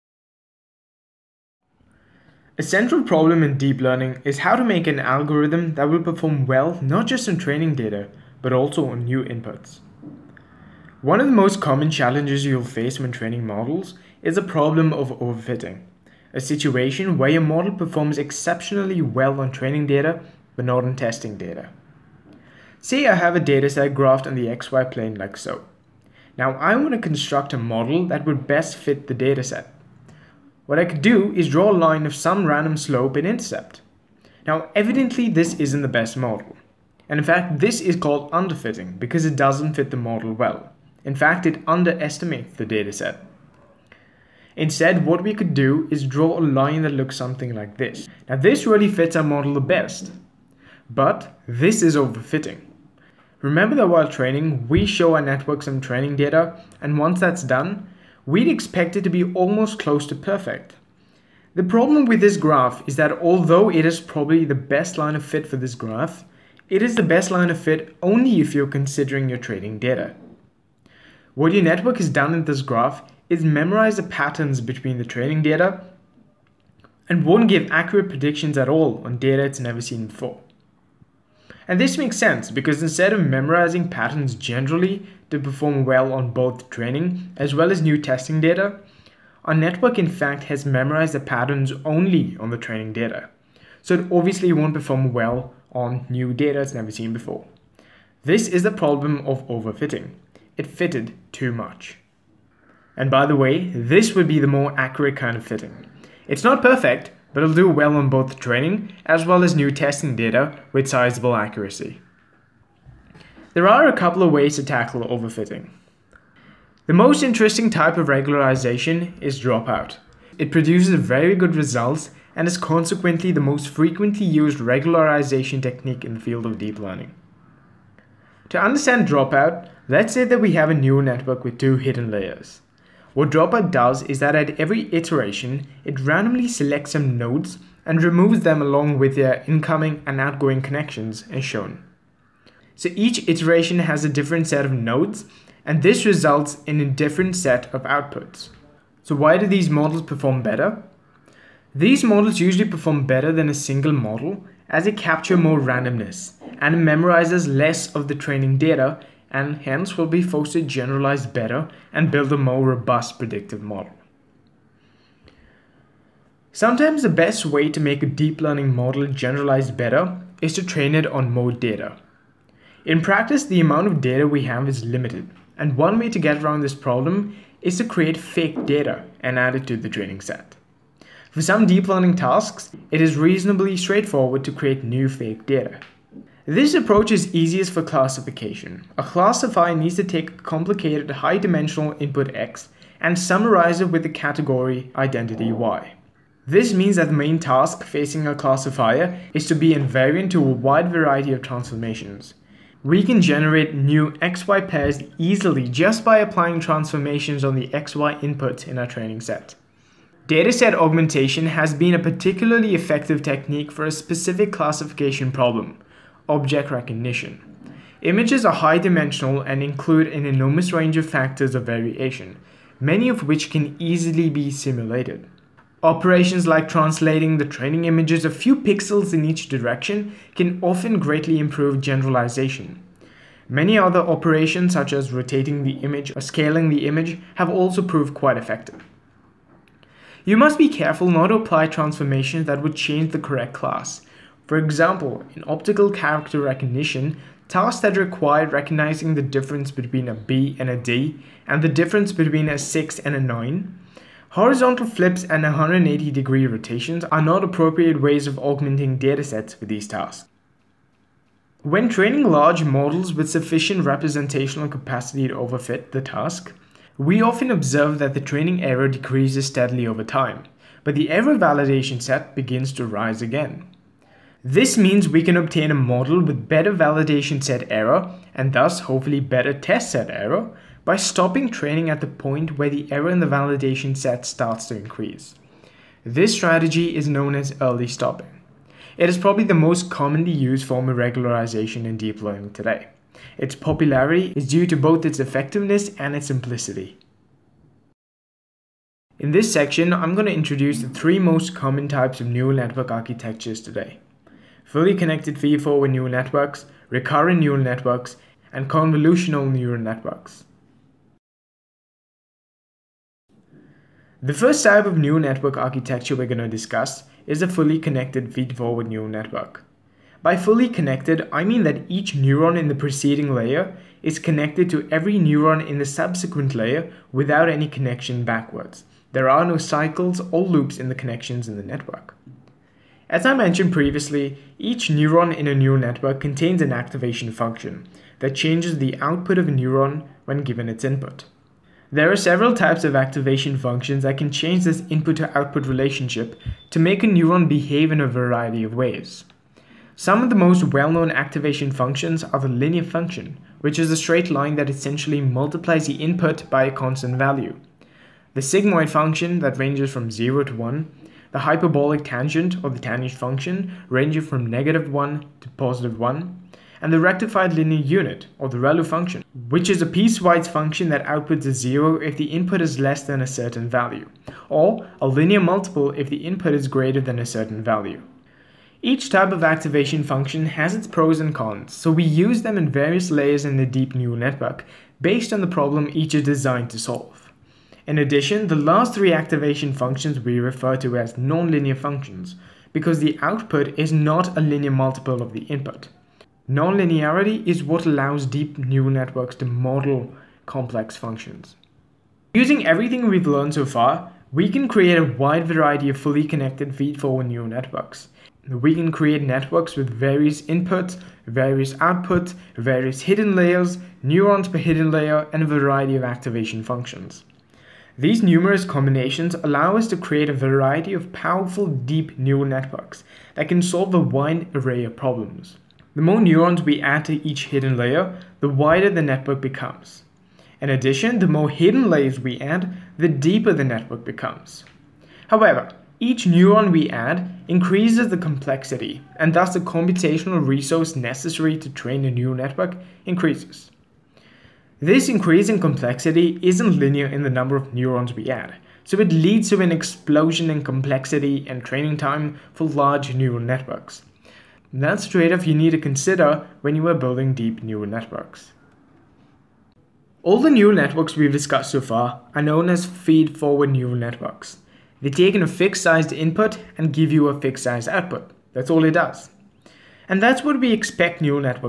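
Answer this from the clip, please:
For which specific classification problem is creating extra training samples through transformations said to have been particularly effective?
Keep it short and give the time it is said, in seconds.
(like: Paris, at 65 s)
object recognition, at 216 s.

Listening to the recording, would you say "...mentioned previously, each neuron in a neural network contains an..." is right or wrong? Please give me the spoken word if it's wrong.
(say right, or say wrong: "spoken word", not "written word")
right.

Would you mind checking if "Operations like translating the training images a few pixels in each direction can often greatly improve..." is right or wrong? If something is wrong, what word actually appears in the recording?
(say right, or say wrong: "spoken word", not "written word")
right.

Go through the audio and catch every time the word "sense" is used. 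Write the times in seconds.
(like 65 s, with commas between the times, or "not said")
82 s.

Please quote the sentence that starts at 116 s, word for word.
The most interesting type of regularization is dropout.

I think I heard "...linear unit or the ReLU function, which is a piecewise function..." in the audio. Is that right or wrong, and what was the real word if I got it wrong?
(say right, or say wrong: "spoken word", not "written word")
right.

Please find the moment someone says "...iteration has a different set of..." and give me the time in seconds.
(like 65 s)
143 s.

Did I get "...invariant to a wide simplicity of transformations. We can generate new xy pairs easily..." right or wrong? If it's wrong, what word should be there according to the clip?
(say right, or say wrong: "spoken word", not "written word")
wrong: "variety", not "simplicity".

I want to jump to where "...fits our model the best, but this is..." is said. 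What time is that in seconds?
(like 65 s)
48 s.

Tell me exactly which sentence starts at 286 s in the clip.
This strategy is known as early stopping.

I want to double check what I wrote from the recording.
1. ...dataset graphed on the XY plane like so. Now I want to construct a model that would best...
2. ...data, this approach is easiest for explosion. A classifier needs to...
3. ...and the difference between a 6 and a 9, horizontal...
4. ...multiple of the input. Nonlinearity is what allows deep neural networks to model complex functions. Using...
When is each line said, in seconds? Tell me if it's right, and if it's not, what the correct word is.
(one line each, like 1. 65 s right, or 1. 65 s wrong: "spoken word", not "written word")
1. 23 s right
2. 185 s wrong: "classification", not "explosion"
3. 251 s right
4. 394 s right.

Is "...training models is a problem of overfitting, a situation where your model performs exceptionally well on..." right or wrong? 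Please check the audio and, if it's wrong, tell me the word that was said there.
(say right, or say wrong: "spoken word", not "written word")
right.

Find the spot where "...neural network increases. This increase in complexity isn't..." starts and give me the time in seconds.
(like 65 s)
442 s.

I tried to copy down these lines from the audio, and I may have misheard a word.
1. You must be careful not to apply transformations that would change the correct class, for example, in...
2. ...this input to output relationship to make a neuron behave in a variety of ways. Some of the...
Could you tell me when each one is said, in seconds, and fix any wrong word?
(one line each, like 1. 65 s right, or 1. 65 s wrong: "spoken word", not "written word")
1. 240 s right
2. 344 s right.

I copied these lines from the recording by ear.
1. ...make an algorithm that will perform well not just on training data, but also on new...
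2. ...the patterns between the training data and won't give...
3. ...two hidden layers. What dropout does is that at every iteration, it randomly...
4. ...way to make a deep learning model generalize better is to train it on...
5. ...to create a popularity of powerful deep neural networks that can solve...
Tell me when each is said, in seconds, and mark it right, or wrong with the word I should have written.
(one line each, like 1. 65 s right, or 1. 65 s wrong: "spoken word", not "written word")
1. 4 s right
2. 73 s right
3. 131 s right
4. 167 s right
5. 419 s wrong: "variety", not "popularity".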